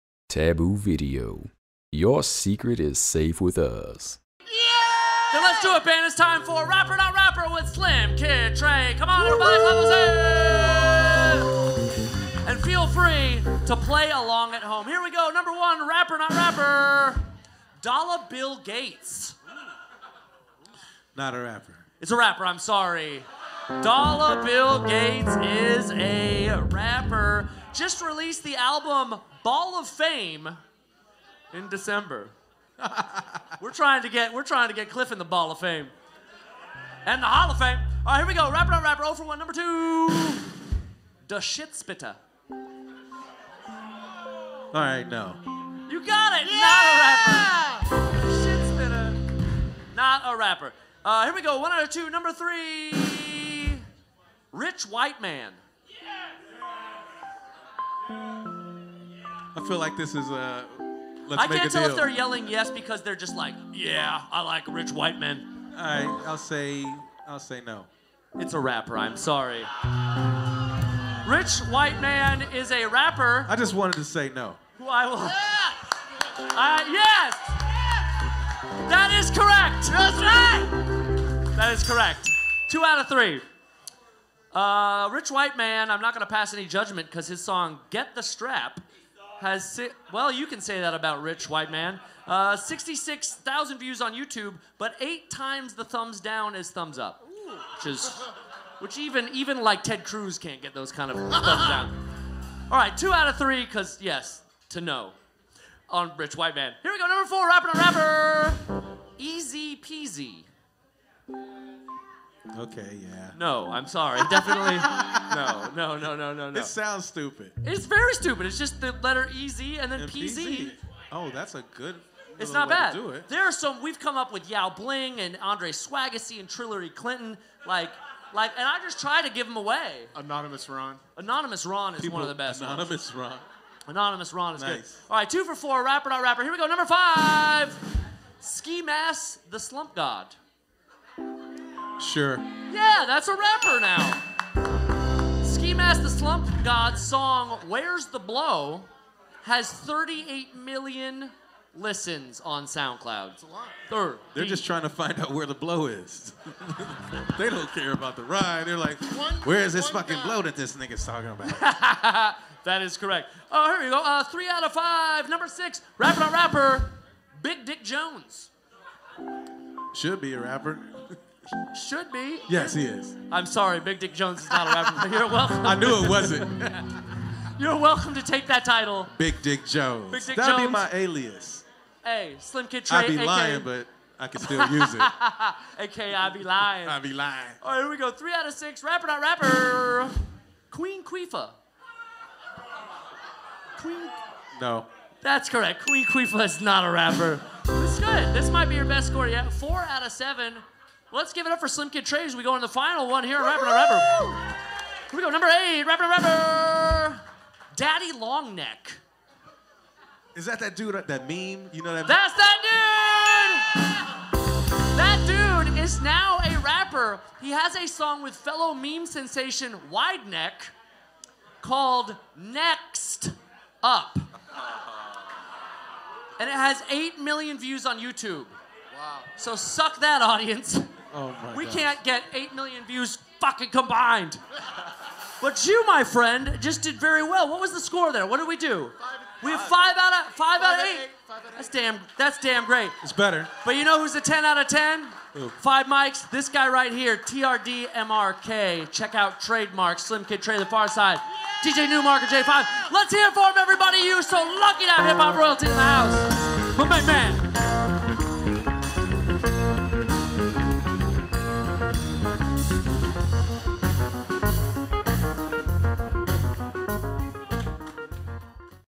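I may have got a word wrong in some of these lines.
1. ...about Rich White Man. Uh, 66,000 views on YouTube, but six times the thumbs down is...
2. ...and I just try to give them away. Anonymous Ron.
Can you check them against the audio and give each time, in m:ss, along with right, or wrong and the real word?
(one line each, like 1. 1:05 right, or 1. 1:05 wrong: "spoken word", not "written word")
1. 1:30 wrong: "eight", not "six"
2. 2:08 right.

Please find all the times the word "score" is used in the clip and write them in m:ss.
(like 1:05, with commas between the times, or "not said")
3:19, 3:57.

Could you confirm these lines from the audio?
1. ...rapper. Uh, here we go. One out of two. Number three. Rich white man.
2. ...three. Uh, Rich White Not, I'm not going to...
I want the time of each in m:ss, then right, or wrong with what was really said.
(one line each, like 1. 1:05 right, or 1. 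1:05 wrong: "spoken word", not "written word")
1. 0:50 right
2. 1:23 wrong: "Man", not "Not".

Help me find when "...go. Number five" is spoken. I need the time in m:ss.
2:16.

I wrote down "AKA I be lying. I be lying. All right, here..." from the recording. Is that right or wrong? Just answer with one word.
right.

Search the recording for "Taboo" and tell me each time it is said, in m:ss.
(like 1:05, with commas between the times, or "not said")
0:00.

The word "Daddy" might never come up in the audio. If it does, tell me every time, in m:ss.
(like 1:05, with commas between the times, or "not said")
3:27.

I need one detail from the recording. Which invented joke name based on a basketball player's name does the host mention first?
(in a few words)
Yao Bling.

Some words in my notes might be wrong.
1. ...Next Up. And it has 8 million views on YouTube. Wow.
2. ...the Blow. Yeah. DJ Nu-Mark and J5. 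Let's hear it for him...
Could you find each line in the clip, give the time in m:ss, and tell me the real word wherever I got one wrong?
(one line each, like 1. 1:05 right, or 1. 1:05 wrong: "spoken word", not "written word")
1. 3:42 right
2. 4:10 wrong: "Pharcyde", not "Blow".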